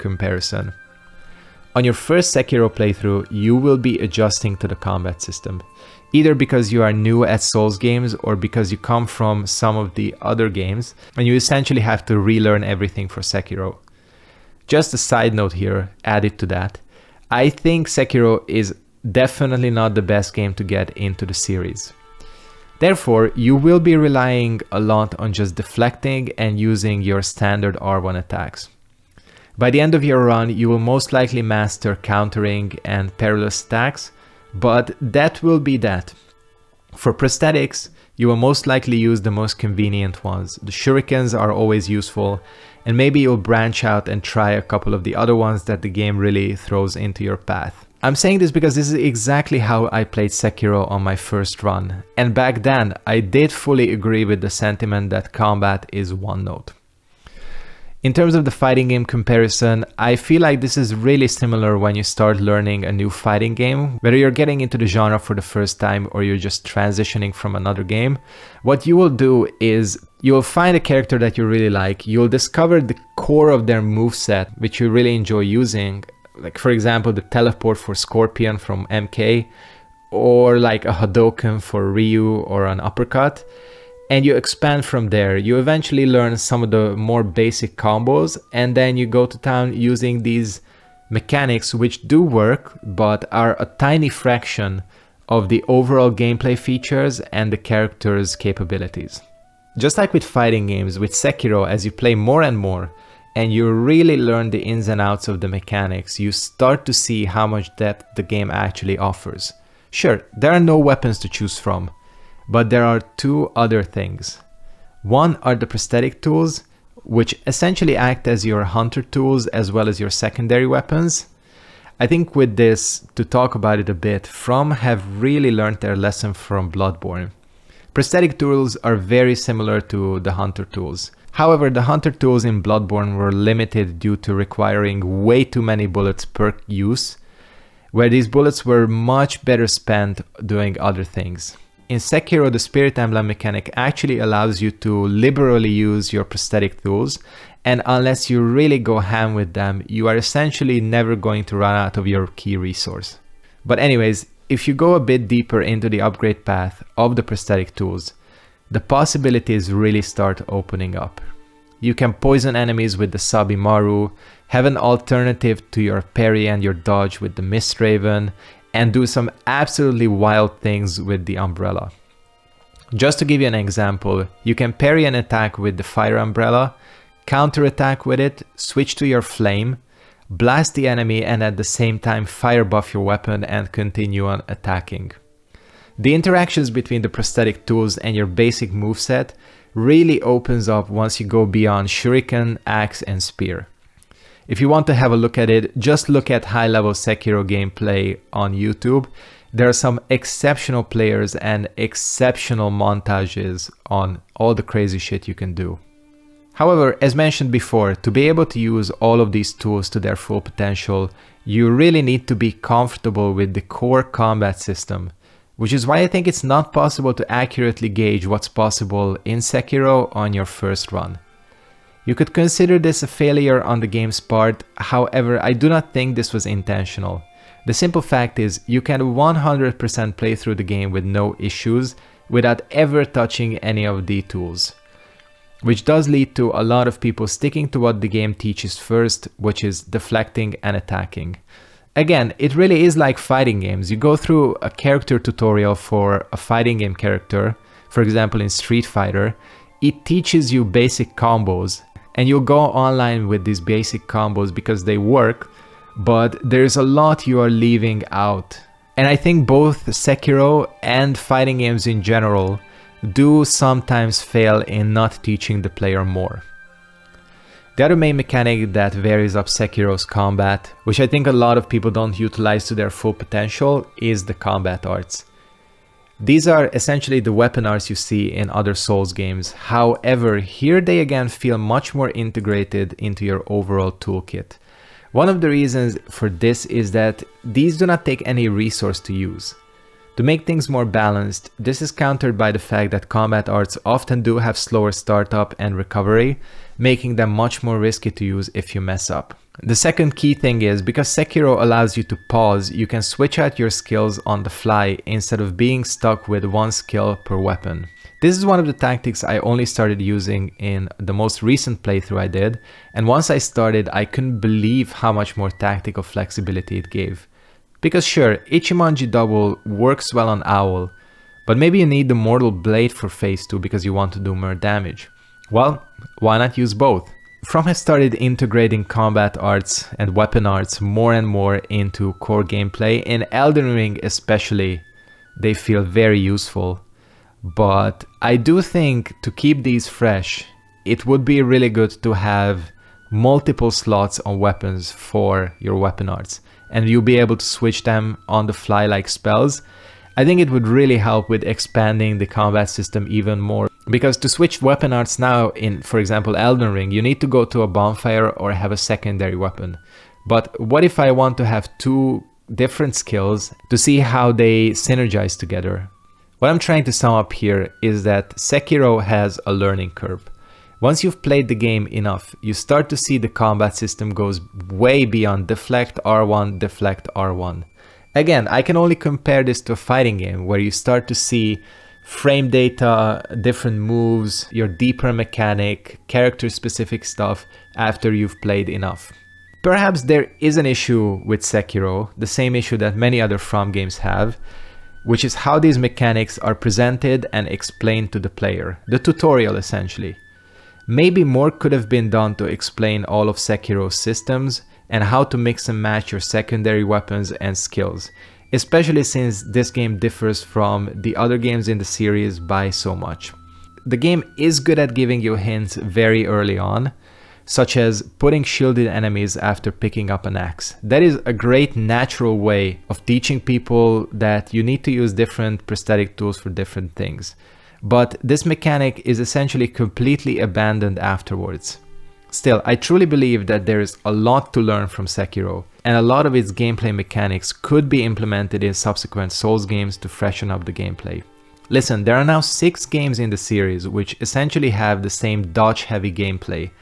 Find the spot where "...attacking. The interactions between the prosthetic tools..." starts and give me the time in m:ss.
3:04.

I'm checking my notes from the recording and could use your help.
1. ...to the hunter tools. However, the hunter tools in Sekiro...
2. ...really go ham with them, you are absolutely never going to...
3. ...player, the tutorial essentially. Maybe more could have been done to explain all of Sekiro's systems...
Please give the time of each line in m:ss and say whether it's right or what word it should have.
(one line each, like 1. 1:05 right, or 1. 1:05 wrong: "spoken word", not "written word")
1. 2:09 wrong: "Bloodborne", not "Sekiro"
2. 2:28 wrong: "essentially", not "absolutely"
3. 6:38 right.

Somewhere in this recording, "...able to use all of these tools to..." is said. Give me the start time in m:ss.
3:28.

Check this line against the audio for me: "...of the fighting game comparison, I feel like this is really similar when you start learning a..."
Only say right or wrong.
right.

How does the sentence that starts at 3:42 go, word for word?
You could consider this a failure on the game's part, however I do not think this was intentional.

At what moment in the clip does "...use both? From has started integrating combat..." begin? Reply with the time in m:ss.
5:26.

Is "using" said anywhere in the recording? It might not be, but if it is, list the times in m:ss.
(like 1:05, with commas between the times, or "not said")
0:26, 1:15, 1:29, 5:09.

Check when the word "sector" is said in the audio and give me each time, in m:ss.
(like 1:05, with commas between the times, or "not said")
not said.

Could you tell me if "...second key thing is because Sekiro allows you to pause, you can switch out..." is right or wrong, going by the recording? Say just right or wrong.
right.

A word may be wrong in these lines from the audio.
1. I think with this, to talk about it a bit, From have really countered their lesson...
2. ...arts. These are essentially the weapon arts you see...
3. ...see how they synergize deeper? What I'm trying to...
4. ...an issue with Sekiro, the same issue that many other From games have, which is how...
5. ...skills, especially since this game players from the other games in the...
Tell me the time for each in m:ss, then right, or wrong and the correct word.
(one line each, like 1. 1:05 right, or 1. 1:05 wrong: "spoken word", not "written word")
1. 2:01 wrong: "learned", not "countered"
2. 4:34 right
3. 6:03 wrong: "together", not "deeper"
4. 6:30 right
5. 6:47 wrong: "differs", not "players".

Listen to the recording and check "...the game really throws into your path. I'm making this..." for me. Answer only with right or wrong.
wrong.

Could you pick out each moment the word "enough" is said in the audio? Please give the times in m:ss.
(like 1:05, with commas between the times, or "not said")
6:11, 6:28.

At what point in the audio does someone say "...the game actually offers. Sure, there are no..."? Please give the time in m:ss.
1:48.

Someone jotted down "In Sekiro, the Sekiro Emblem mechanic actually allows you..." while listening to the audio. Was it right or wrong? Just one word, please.
wrong.